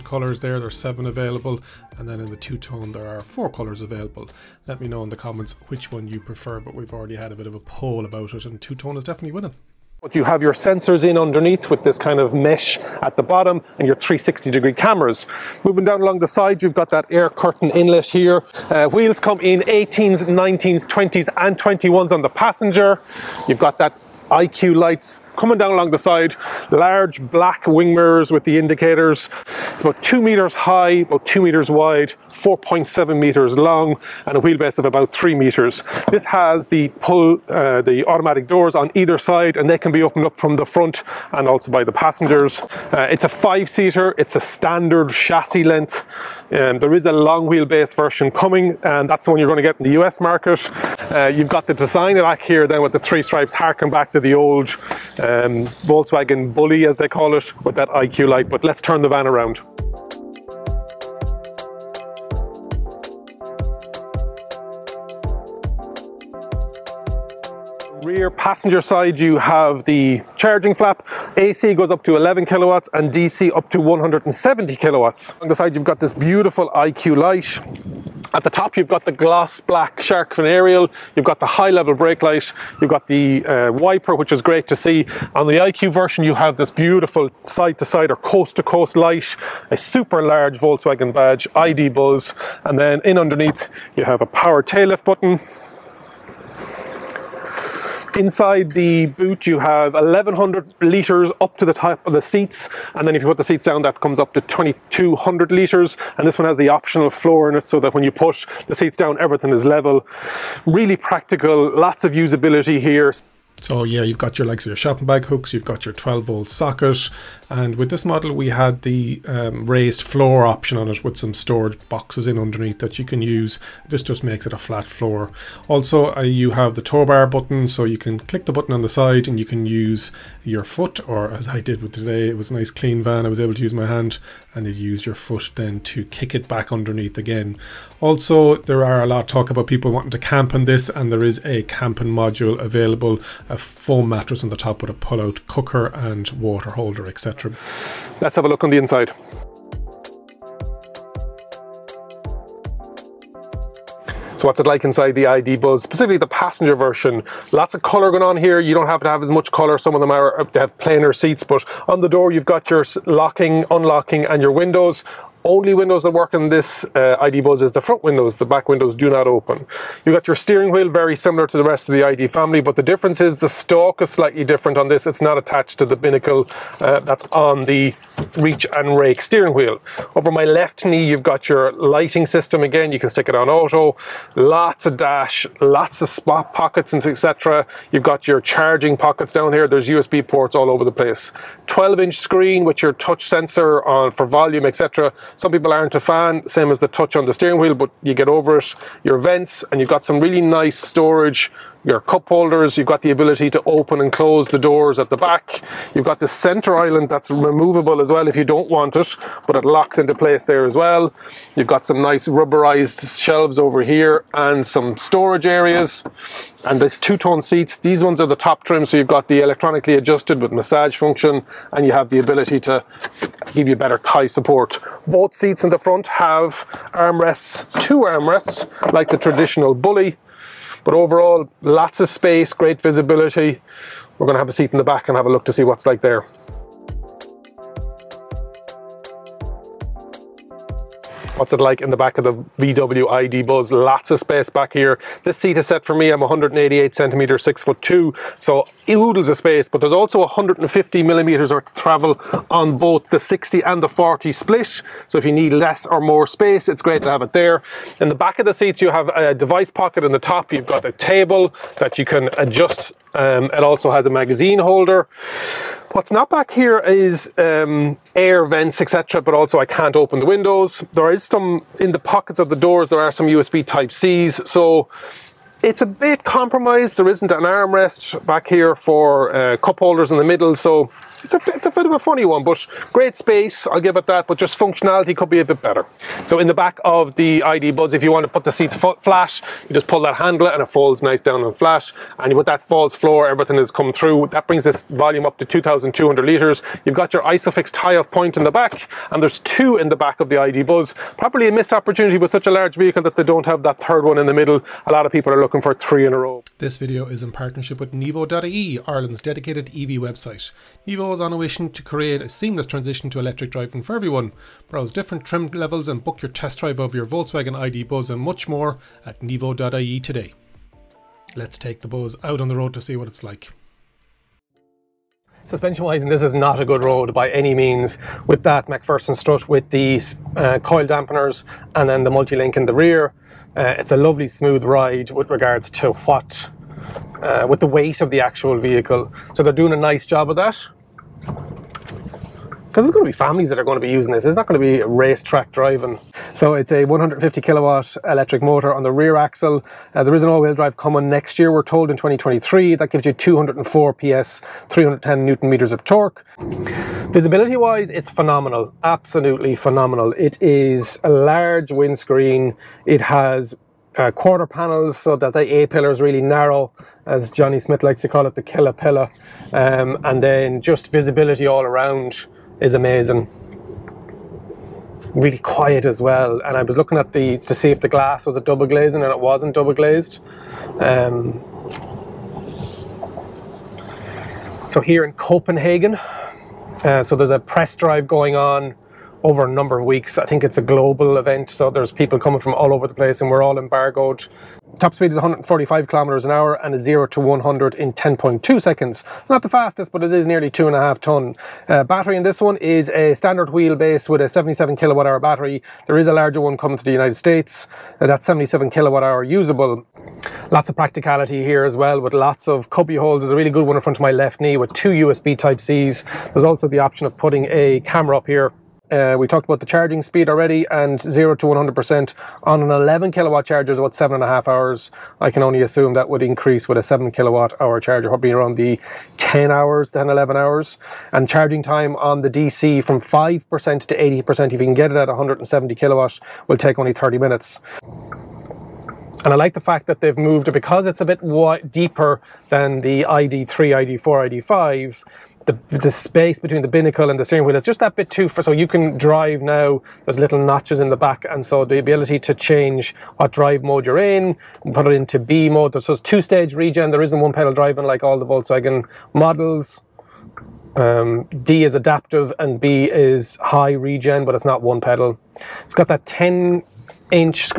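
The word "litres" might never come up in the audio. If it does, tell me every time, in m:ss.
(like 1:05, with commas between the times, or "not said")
1:40, 1:45, 4:56.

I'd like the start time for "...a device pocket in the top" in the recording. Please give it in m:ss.
4:19.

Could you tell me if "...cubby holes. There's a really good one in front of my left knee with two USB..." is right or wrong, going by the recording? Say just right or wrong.
right.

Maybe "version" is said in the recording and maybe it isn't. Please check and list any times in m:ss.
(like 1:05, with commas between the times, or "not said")
0:47, 1:25, 2:36.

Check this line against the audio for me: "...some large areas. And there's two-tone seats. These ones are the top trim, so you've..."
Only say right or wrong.
wrong.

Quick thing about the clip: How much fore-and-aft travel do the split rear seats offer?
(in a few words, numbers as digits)
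150 millimeters.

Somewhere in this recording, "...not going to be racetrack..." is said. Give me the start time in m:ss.
5:44.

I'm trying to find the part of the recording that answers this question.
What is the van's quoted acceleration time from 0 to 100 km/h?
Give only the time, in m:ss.
6:37.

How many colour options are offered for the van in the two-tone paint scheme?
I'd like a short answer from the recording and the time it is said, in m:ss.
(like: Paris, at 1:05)
4, at 0:03.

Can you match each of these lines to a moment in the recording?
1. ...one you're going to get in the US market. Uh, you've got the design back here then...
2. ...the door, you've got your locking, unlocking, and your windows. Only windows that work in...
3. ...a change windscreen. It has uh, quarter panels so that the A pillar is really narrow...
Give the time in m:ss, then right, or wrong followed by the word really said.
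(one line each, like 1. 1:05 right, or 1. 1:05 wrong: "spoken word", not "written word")
1. 0:49 right
2. 2:42 right
3. 6:01 wrong: "large", not "change".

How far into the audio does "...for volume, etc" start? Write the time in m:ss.
3:14.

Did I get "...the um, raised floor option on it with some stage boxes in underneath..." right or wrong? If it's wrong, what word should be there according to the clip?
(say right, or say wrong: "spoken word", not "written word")
wrong: "storage", not "stage".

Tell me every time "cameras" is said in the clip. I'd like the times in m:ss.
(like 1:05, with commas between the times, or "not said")
0:14, 6:57.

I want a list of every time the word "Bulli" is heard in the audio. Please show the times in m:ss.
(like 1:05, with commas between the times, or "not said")
0:56, 3:49.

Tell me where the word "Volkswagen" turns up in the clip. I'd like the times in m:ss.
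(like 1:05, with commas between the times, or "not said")
0:55, 1:30, 5:17, 7:38.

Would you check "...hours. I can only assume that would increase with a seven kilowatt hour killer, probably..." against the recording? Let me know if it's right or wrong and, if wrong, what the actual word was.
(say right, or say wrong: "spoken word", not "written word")
wrong: "charger", not "killer".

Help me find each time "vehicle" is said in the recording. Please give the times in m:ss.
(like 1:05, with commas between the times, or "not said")
5:02, 5:38.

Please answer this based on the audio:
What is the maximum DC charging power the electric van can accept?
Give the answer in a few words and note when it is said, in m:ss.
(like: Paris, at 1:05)
170 kilowatts, at 1:13.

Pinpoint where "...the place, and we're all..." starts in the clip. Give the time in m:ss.
6:32.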